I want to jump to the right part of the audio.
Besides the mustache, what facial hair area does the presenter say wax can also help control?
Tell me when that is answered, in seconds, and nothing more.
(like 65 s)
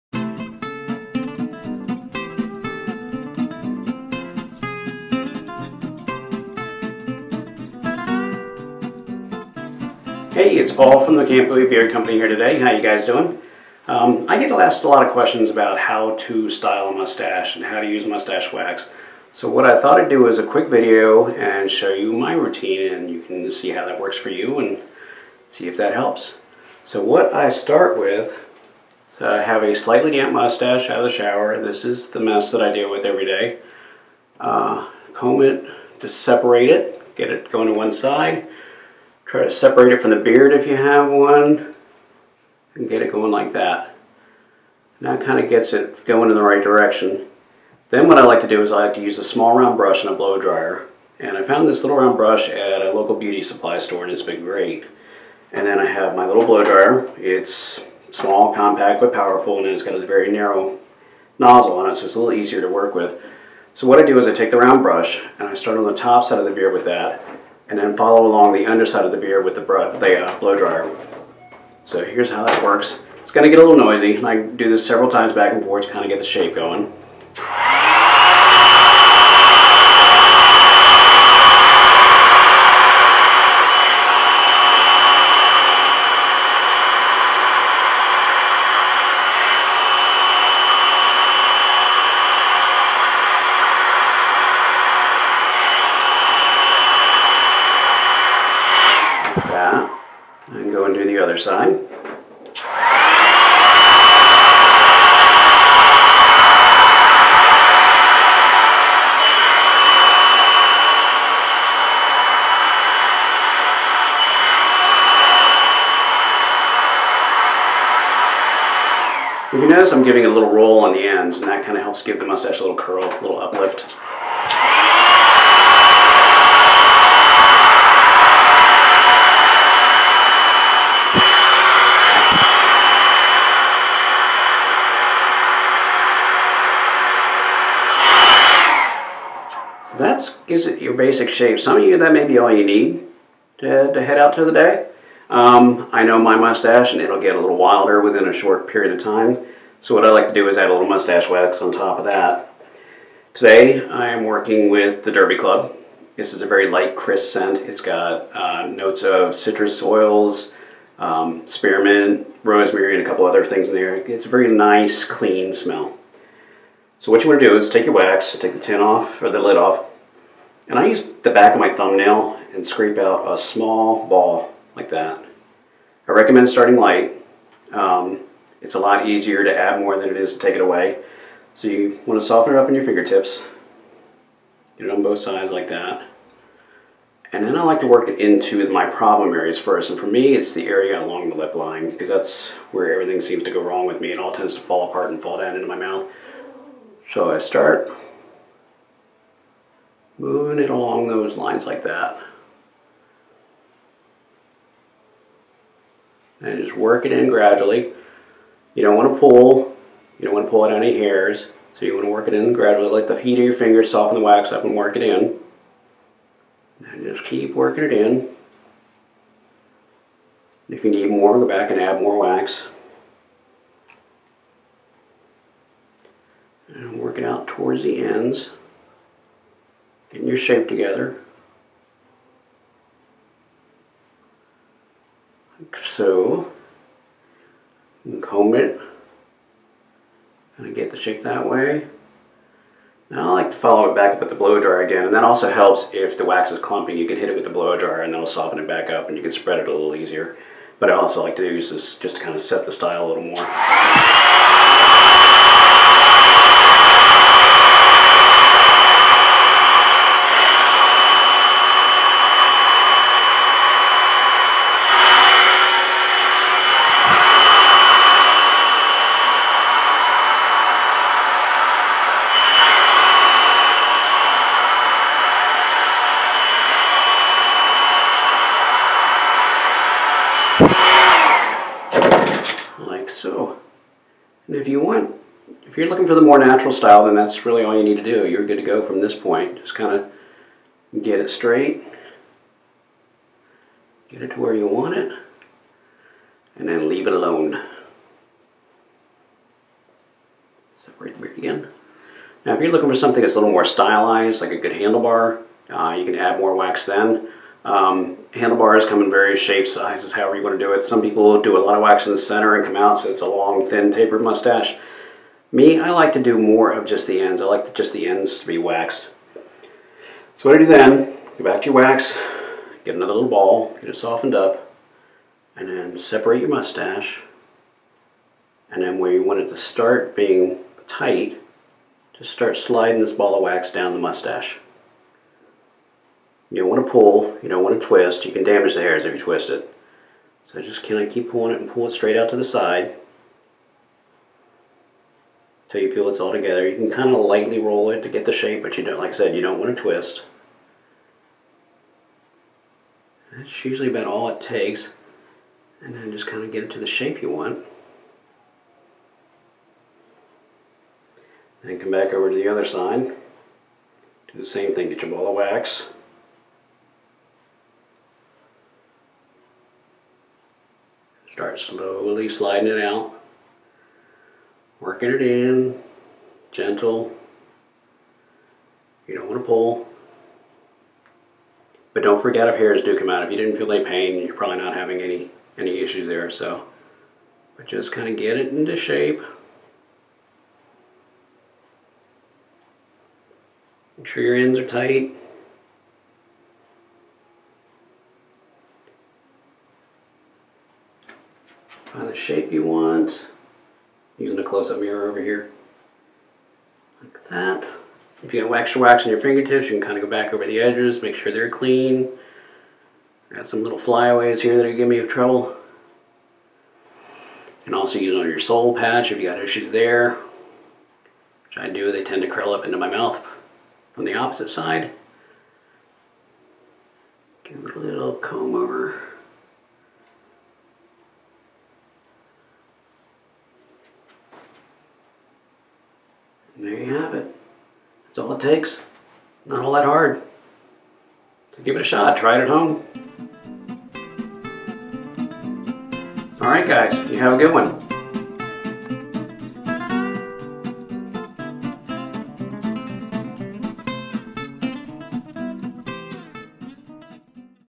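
418 s.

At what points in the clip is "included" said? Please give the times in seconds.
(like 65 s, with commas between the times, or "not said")
not said.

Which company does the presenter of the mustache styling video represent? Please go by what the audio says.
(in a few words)
Camp Bowie Beard Company.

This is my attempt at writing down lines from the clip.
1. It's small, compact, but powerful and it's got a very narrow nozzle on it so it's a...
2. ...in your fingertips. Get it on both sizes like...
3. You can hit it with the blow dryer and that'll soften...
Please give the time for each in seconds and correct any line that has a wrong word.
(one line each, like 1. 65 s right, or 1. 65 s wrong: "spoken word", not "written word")
1. 57 s right
2. 182 s wrong: "sides", not "sizes"
3. 246 s right.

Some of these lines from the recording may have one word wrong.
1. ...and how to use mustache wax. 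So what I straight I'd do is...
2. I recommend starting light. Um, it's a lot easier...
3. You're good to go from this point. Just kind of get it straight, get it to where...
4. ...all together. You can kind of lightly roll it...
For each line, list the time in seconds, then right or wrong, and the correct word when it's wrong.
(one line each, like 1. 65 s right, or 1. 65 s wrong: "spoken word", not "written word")
1. 17 s wrong: "thought", not "straight"
2. 176 s right
3. 288 s right
4. 346 s right.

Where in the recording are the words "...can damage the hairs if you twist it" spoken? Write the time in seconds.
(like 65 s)
338 s.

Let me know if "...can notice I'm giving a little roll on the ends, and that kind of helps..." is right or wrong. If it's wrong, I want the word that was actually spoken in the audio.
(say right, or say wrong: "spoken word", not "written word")
right.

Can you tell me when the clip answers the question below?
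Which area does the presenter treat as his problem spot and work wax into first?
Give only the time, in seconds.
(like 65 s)
191 s.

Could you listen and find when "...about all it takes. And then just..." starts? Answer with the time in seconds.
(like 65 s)
353 s.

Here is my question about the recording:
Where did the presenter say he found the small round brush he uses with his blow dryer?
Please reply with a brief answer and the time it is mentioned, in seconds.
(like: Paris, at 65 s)
local beauty supply store, at 52 s.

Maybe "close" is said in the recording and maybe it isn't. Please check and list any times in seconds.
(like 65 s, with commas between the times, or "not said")
404 s.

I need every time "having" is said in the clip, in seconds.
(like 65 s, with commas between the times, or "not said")
384 s.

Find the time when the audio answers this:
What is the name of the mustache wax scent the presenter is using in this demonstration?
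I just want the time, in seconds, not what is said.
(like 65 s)
155 s.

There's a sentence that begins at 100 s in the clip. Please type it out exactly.
And go and do the other side.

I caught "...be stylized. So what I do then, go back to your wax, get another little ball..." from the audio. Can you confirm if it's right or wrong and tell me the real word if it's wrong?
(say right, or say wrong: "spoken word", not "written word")
wrong: "waxed", not "stylized".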